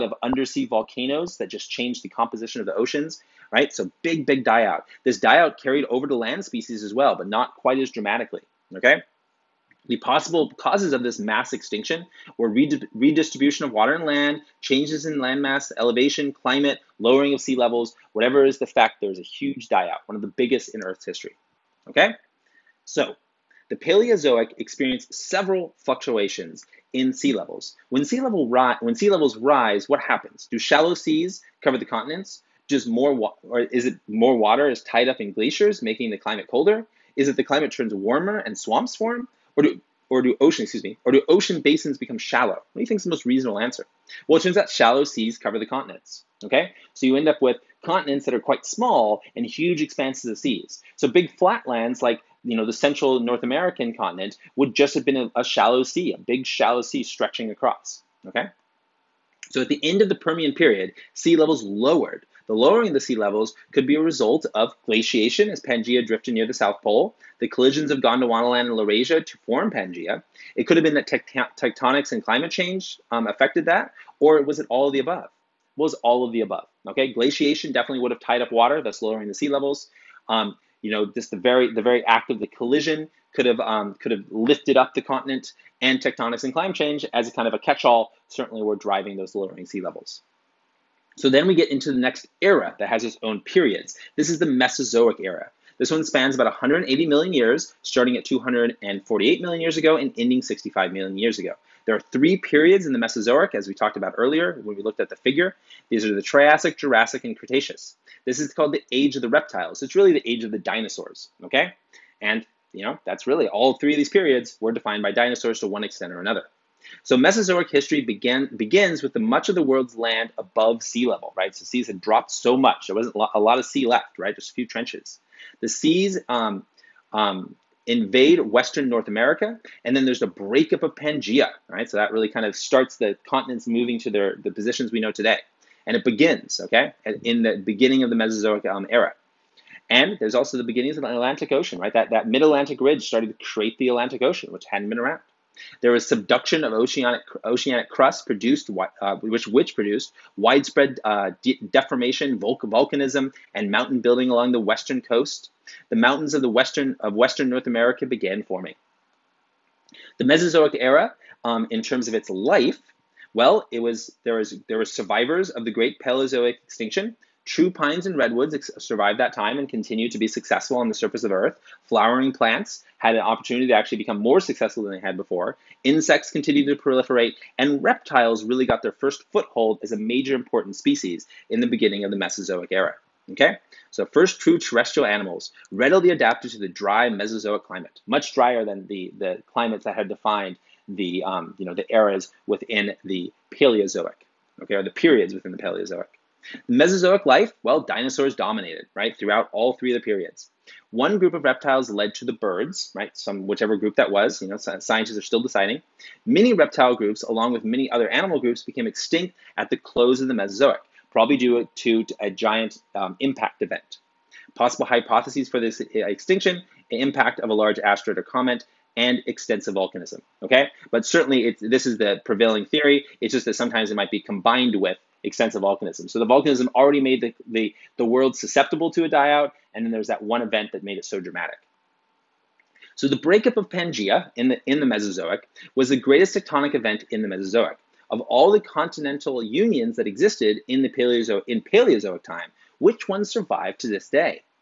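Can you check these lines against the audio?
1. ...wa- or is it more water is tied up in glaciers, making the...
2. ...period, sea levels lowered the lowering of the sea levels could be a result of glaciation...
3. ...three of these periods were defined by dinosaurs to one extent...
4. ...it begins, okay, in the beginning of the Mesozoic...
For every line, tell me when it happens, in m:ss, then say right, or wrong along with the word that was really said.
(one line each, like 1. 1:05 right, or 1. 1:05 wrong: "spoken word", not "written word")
1. 0:33 right
2. 1:00 right
3. 1:53 right
4. 2:15 right.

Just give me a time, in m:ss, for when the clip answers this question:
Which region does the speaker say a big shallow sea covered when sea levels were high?
0:52.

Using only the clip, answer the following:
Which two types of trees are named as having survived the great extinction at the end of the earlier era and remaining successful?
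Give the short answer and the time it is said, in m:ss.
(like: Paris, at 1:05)
Pines and redwoods, at 2:47.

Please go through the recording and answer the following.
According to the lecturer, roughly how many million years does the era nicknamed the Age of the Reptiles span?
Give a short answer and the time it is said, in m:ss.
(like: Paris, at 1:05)
180 million years, at 1:36.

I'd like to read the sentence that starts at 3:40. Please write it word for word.
But certainly this is the prevailing theory.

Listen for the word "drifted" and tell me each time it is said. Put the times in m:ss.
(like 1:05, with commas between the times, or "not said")
1:06.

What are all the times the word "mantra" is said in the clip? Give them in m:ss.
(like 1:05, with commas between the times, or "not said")
not said.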